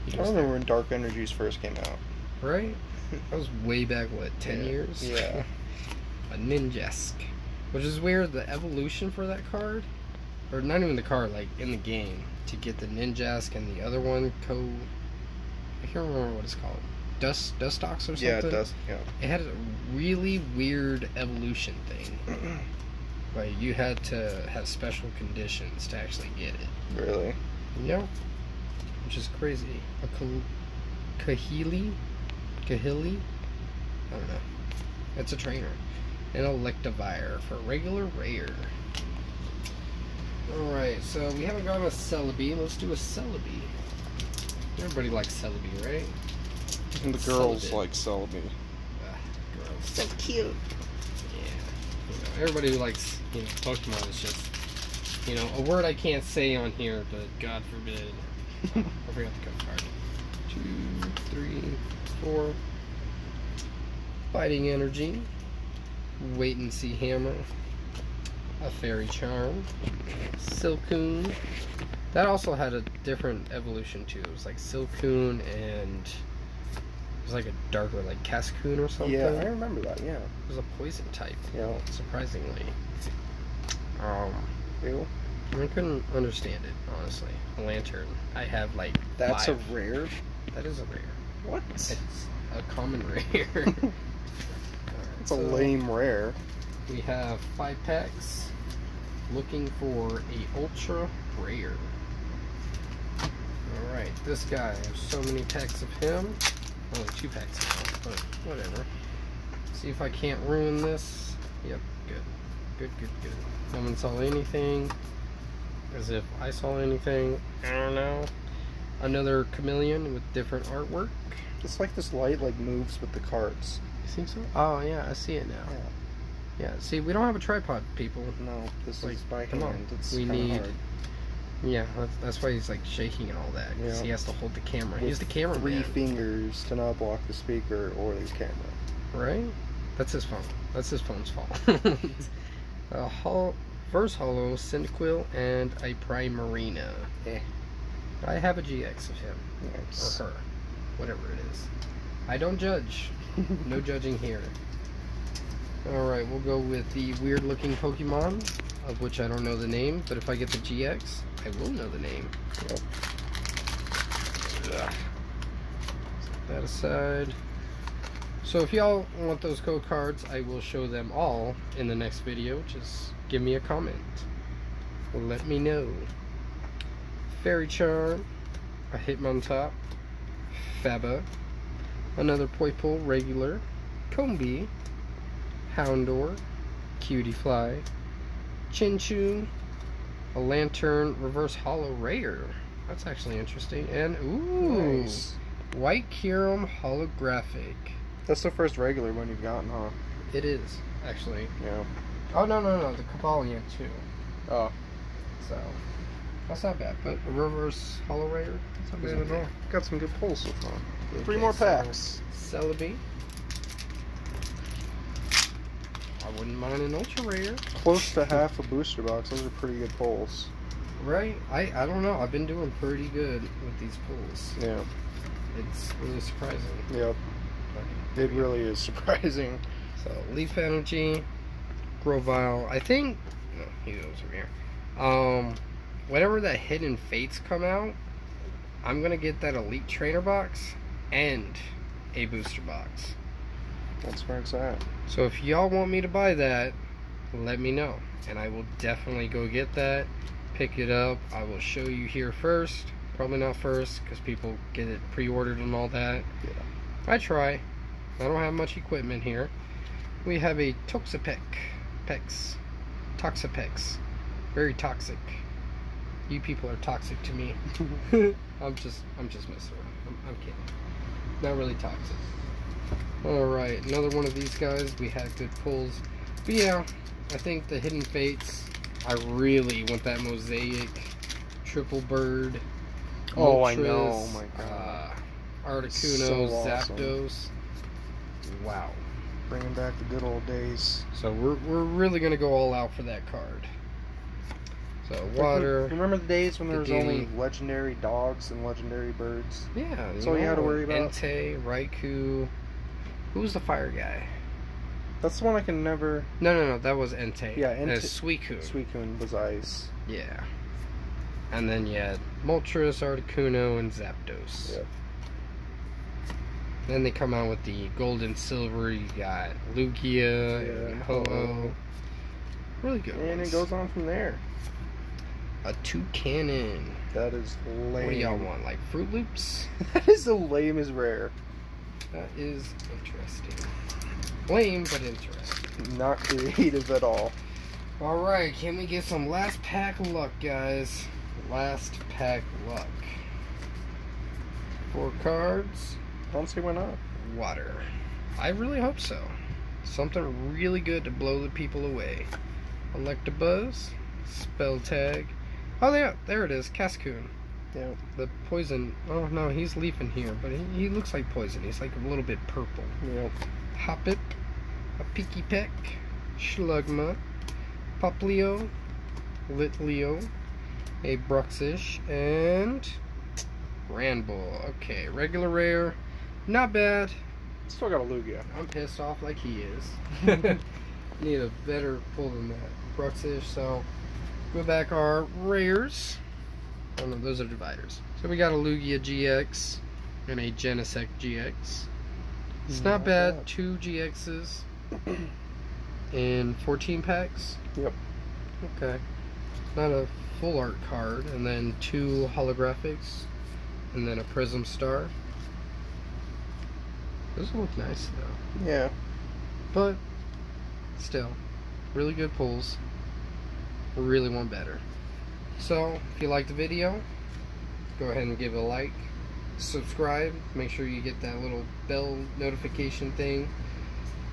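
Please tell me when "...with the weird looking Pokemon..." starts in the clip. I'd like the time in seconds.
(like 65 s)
156 s.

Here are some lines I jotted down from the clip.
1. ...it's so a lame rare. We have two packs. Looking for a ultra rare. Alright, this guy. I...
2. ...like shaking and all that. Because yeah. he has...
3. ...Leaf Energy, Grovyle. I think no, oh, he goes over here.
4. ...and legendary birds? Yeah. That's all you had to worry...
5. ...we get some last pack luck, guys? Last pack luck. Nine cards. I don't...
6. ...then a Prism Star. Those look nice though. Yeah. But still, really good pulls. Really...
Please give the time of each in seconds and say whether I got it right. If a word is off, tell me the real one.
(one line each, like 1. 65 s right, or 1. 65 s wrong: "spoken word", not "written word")
1. 95 s wrong: "five", not "two"
2. 132 s right
3. 230 s right
4. 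298 s right
5. 338 s wrong: "Four", not "Nine"
6. 404 s right.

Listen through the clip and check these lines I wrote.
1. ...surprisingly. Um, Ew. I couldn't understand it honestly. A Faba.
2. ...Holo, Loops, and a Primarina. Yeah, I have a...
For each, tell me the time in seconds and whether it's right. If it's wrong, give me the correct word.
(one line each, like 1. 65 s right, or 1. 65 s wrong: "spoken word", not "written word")
1. 81 s wrong: "Lanturn", not "Faba"
2. 144 s wrong: "Cyndaquil", not "Loops".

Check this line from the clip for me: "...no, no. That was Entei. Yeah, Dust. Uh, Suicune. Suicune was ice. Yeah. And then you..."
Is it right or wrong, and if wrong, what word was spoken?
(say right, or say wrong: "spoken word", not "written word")
wrong: "Entei", not "Dust".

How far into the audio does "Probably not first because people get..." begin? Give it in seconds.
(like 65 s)
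253 s.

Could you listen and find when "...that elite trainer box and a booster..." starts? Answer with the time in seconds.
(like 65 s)
239 s.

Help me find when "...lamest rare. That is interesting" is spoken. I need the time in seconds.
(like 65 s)
330 s.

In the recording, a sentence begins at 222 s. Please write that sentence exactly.
I've been doing pretty good with these pulls.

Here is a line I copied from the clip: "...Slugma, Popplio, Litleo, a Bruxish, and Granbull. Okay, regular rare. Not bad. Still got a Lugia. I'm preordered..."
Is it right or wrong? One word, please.
wrong.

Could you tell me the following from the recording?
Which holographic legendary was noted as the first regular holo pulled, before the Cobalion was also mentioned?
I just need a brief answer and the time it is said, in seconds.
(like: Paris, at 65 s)
White Kyurem, at 195 s.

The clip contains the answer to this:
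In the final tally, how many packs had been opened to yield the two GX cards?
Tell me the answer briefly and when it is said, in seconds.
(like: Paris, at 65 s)
14, at 396 s.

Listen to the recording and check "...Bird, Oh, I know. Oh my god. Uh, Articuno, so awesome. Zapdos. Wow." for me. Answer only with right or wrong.
right.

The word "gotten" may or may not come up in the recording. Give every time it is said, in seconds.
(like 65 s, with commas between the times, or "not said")
41 s, 199 s.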